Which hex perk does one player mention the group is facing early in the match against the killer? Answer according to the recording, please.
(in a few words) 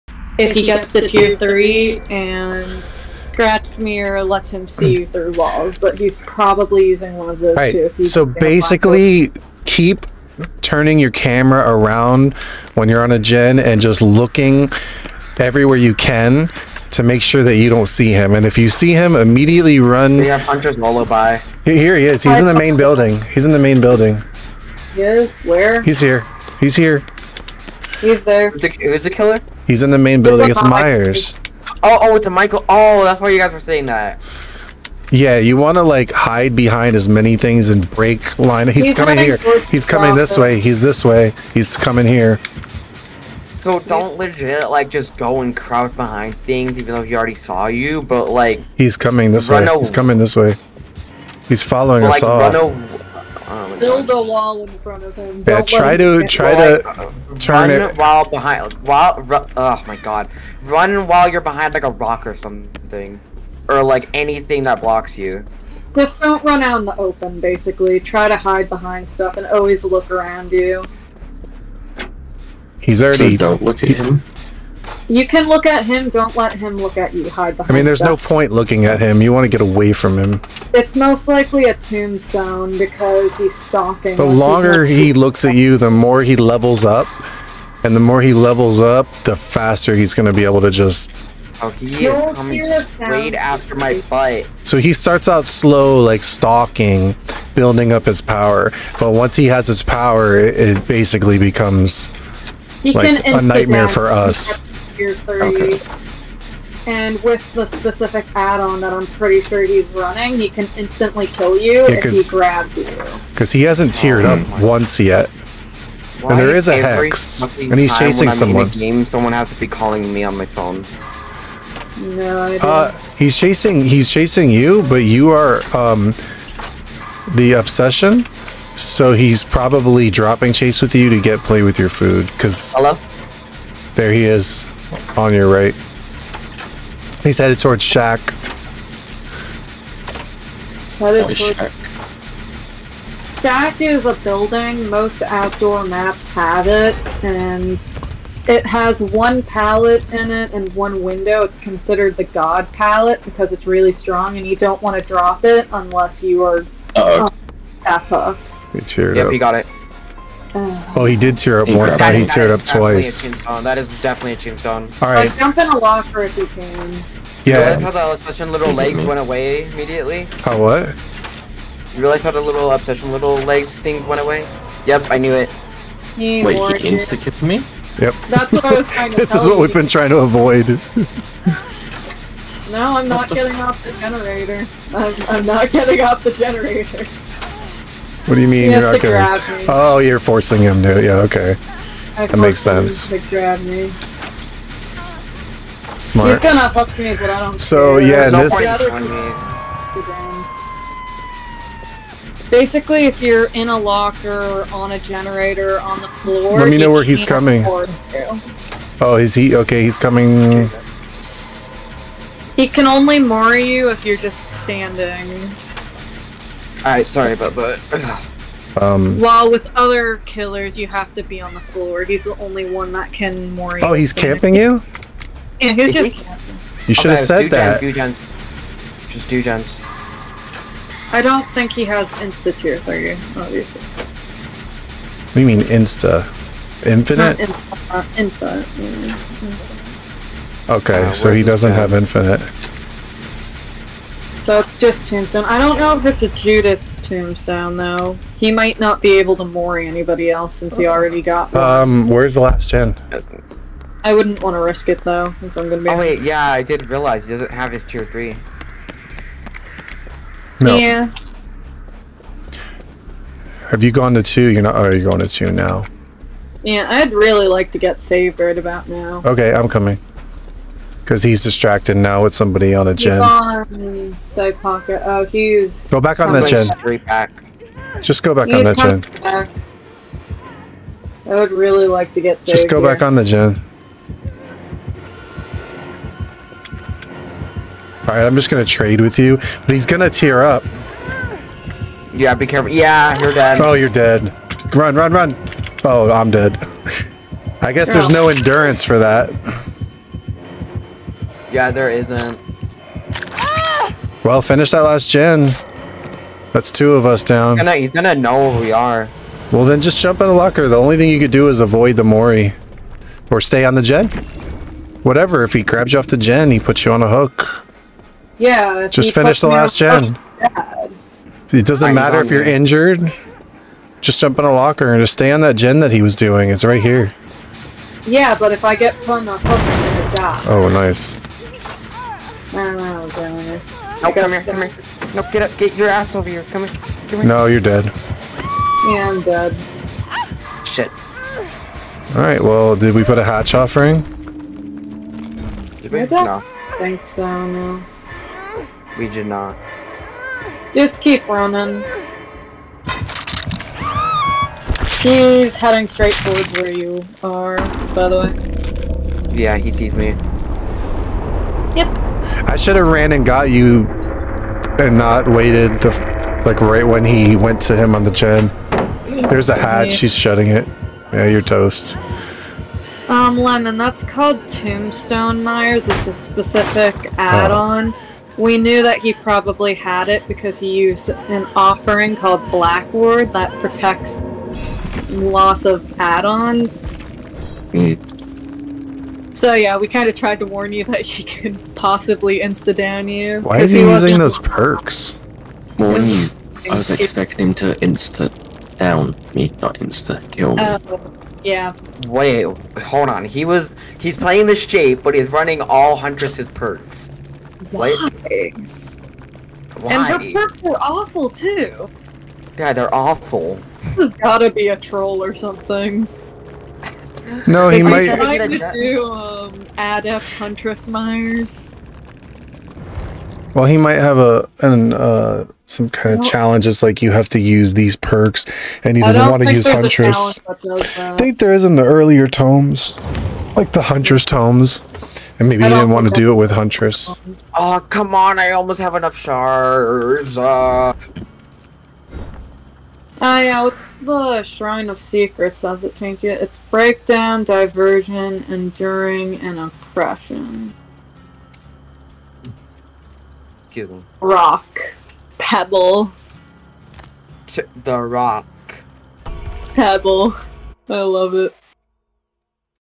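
Huntress Lullaby.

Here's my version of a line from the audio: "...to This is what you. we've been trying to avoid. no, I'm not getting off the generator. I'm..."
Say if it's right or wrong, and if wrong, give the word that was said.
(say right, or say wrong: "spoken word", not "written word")
right.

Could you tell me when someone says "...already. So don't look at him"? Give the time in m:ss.
1:13.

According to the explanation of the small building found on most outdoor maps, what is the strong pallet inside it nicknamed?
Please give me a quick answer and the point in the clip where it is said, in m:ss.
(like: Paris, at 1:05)
God pallet, at 2:32.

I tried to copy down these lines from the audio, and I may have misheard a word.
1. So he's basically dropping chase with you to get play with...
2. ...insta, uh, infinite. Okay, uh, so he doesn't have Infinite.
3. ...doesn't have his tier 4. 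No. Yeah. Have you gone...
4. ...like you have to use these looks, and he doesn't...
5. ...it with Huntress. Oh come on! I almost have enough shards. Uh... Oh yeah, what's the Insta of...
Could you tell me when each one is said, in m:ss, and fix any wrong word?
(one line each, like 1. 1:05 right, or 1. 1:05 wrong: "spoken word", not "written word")
1. 2:08 wrong: "probably", not "basically"
2. 3:57 right
3. 4:17 wrong: "3", not "4"
4. 7:06 wrong: "perks", not "looks"
5. 7:16 wrong: "Shrine", not "Insta".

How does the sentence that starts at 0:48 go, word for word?
But like, he's coming this way.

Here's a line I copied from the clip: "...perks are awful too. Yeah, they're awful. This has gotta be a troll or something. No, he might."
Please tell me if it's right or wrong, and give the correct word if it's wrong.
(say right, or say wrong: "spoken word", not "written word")
right.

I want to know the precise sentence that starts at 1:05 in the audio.
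Just don't run out in the open, basically.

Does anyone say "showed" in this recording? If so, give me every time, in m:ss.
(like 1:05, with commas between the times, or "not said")
not said.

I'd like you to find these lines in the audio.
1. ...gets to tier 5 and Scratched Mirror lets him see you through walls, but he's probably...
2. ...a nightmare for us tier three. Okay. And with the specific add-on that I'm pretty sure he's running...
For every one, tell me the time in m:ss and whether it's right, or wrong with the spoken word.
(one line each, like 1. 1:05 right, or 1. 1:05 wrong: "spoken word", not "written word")
1. 0:00 wrong: "3", not "5"
2. 1:43 right.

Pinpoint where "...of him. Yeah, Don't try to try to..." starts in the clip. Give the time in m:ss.
0:55.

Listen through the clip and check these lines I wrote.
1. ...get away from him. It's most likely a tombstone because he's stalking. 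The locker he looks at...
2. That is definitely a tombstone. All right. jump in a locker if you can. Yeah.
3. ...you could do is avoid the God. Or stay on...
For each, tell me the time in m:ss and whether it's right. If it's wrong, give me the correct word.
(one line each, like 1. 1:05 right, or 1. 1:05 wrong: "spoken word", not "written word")
1. 1:19 wrong: "longer", not "locker"
2. 2:43 right
3. 5:11 wrong: "Mori", not "God".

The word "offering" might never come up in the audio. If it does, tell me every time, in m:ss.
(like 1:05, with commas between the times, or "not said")
5:43, 6:21.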